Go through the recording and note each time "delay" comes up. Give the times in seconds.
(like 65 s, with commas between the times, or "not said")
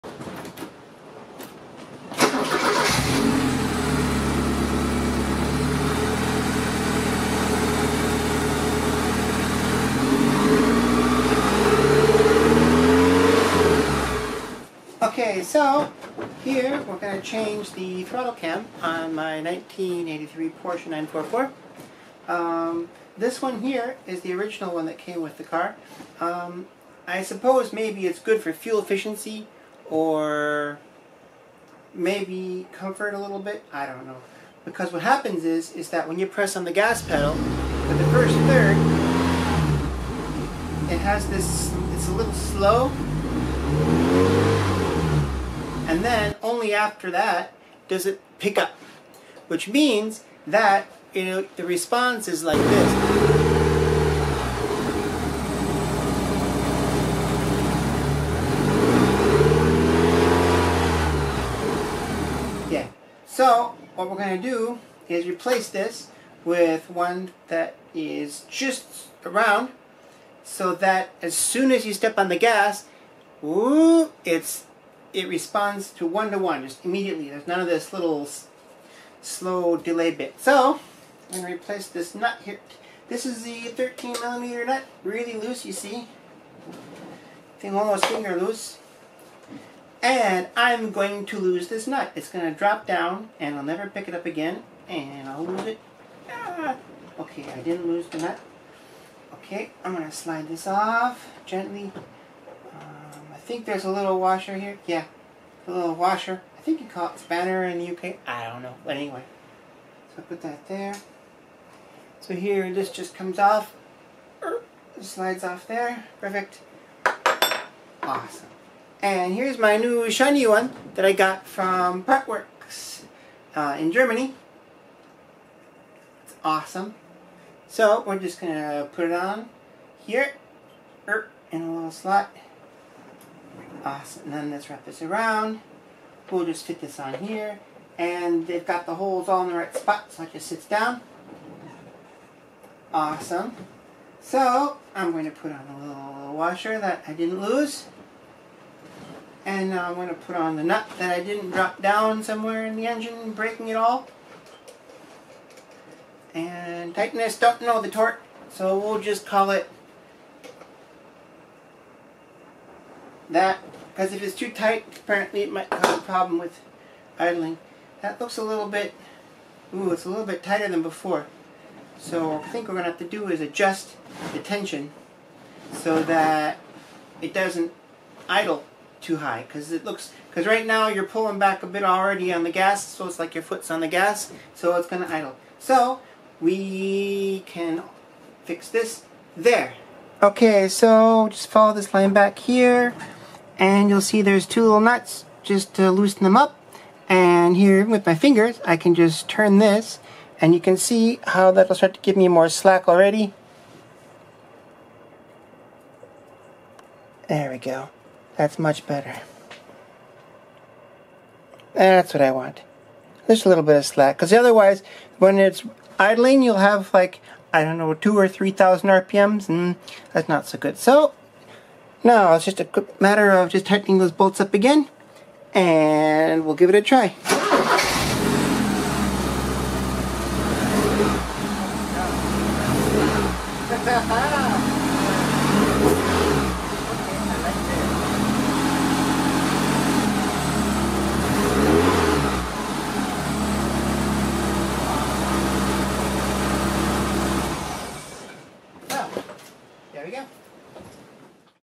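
79 s.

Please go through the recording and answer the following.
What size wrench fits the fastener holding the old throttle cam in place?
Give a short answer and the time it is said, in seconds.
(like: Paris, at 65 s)
13 millimeter, at 83 s.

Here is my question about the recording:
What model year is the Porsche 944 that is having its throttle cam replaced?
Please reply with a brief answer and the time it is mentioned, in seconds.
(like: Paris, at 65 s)
1983, at 19 s.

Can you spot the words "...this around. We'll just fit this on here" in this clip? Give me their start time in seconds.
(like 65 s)
134 s.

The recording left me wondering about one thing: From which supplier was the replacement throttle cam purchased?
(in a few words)
Partworks.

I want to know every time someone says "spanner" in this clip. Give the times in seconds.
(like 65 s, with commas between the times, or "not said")
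107 s.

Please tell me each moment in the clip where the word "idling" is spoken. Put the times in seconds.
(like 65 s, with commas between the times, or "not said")
167 s, 215 s.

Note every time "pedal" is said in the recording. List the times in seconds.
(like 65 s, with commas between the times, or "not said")
37 s.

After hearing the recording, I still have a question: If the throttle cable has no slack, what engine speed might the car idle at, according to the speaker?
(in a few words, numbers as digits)
2,000 or 3,000 RPM.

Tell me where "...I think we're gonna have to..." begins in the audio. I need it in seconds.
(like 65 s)
172 s.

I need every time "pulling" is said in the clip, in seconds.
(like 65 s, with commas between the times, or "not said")
181 s.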